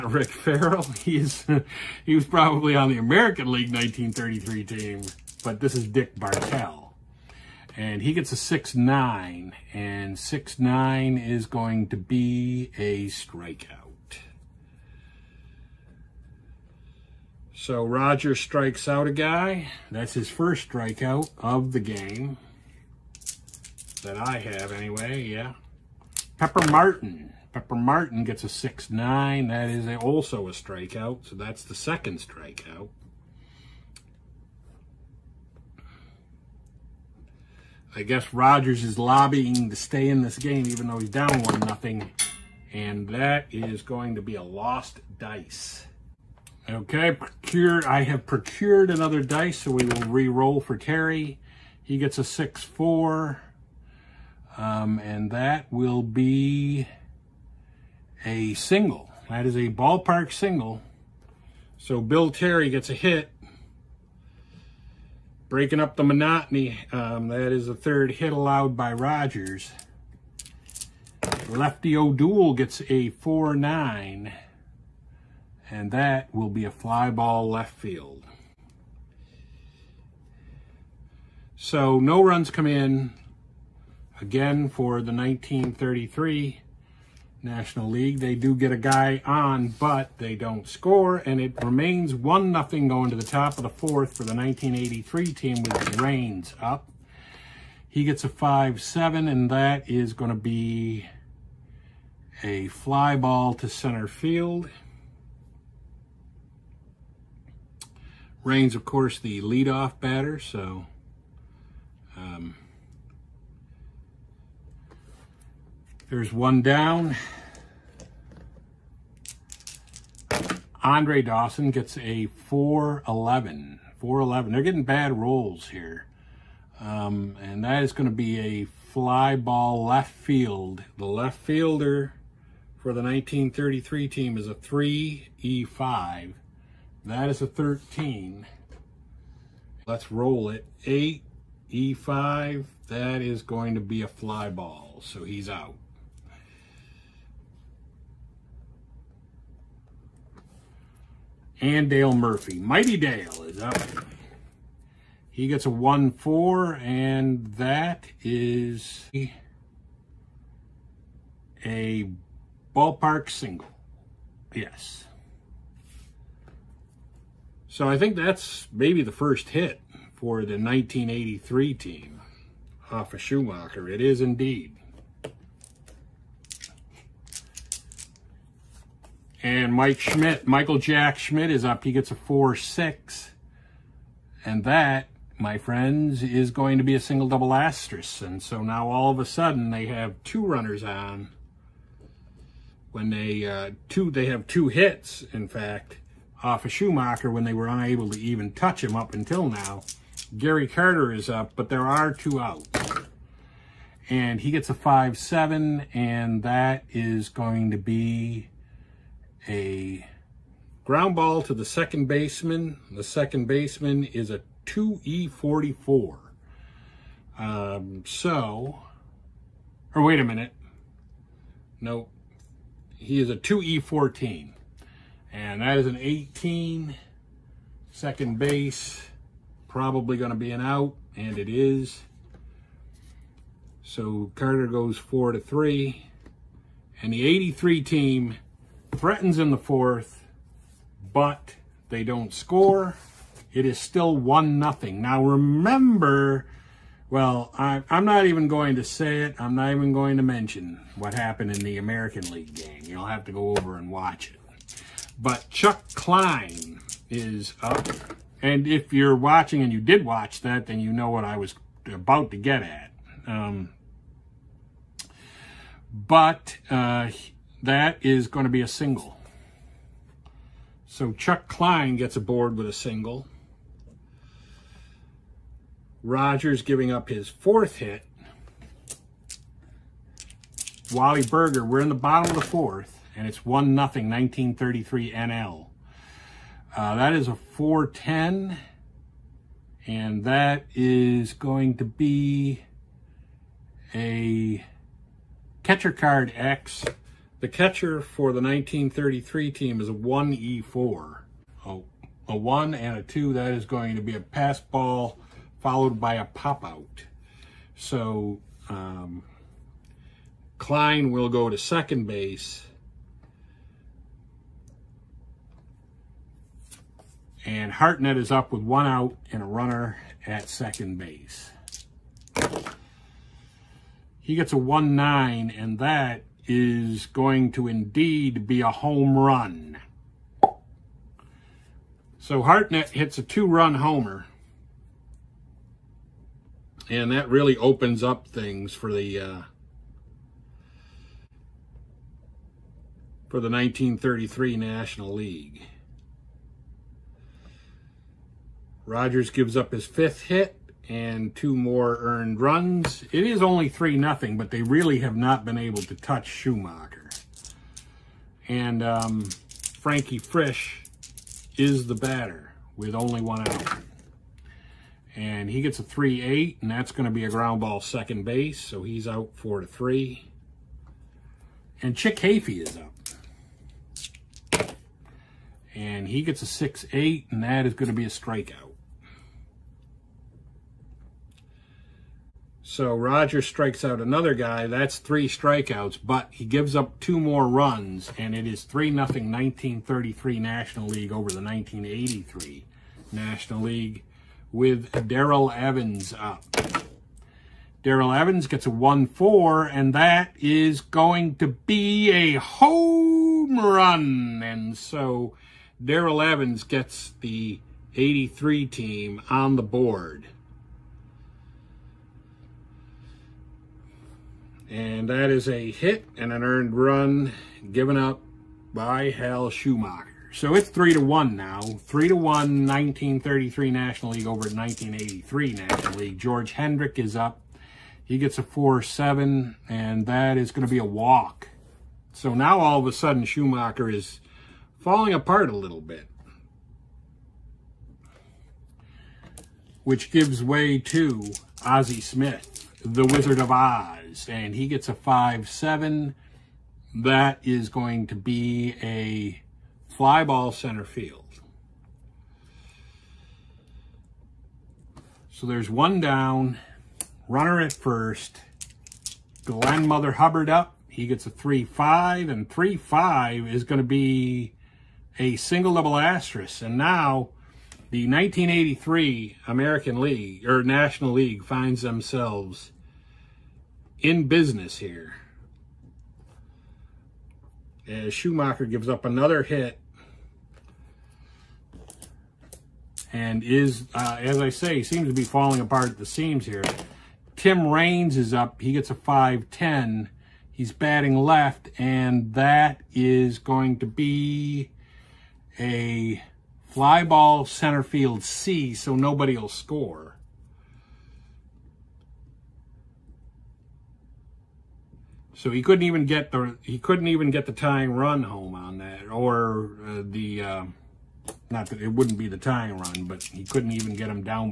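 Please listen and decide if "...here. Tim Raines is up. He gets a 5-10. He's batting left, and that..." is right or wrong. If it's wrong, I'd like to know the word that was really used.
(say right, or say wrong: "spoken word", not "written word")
right.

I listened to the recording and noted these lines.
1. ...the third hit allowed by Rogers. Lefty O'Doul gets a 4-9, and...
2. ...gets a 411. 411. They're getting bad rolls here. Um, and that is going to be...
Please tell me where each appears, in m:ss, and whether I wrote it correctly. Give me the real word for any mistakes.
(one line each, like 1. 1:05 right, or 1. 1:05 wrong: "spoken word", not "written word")
1. 1:07 right
2. 2:01 right.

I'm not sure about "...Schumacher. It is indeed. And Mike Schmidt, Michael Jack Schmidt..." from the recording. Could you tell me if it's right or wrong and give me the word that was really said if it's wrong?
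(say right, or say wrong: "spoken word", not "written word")
right.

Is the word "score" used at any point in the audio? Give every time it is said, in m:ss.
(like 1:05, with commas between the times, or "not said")
1:30, 4:02, 8:19.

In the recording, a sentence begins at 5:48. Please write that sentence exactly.
Rogers gives up his fifth hit and two more earned runs.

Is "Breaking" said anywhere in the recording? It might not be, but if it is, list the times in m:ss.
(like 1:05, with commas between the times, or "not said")
1:05.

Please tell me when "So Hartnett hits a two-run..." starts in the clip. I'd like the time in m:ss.
5:32.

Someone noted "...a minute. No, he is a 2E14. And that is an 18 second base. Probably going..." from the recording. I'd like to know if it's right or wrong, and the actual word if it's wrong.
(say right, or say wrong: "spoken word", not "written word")
right.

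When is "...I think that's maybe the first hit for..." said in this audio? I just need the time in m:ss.
2:47.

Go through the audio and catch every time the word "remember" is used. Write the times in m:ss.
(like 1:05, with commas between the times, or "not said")
4:05.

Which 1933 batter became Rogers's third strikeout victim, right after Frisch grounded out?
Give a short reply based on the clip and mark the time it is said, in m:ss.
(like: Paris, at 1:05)
Chick Hafey, at 6:11.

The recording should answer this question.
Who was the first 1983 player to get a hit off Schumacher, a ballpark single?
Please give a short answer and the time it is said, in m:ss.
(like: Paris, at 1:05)
Dale Murphy, at 2:31.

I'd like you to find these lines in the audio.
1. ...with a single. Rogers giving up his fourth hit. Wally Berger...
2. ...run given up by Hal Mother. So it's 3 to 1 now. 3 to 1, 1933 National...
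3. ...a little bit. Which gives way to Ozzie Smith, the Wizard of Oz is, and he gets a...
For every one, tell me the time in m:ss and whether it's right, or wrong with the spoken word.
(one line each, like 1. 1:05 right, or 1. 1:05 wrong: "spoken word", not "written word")
1. 4:32 right
2. 6:56 wrong: "Schumacher", not "Mother"
3. 7:15 right.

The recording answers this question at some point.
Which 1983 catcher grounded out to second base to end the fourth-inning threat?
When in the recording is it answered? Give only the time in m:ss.
3:20.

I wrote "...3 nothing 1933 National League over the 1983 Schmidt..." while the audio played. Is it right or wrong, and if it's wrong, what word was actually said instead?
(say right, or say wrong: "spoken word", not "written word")
wrong: "National", not "Schmidt".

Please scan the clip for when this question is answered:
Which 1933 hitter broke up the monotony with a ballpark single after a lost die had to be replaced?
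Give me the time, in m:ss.
1:02.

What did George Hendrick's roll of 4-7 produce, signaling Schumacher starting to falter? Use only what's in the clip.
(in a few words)
a walk.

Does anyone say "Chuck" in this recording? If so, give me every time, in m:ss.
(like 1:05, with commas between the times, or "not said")
4:15, 4:31.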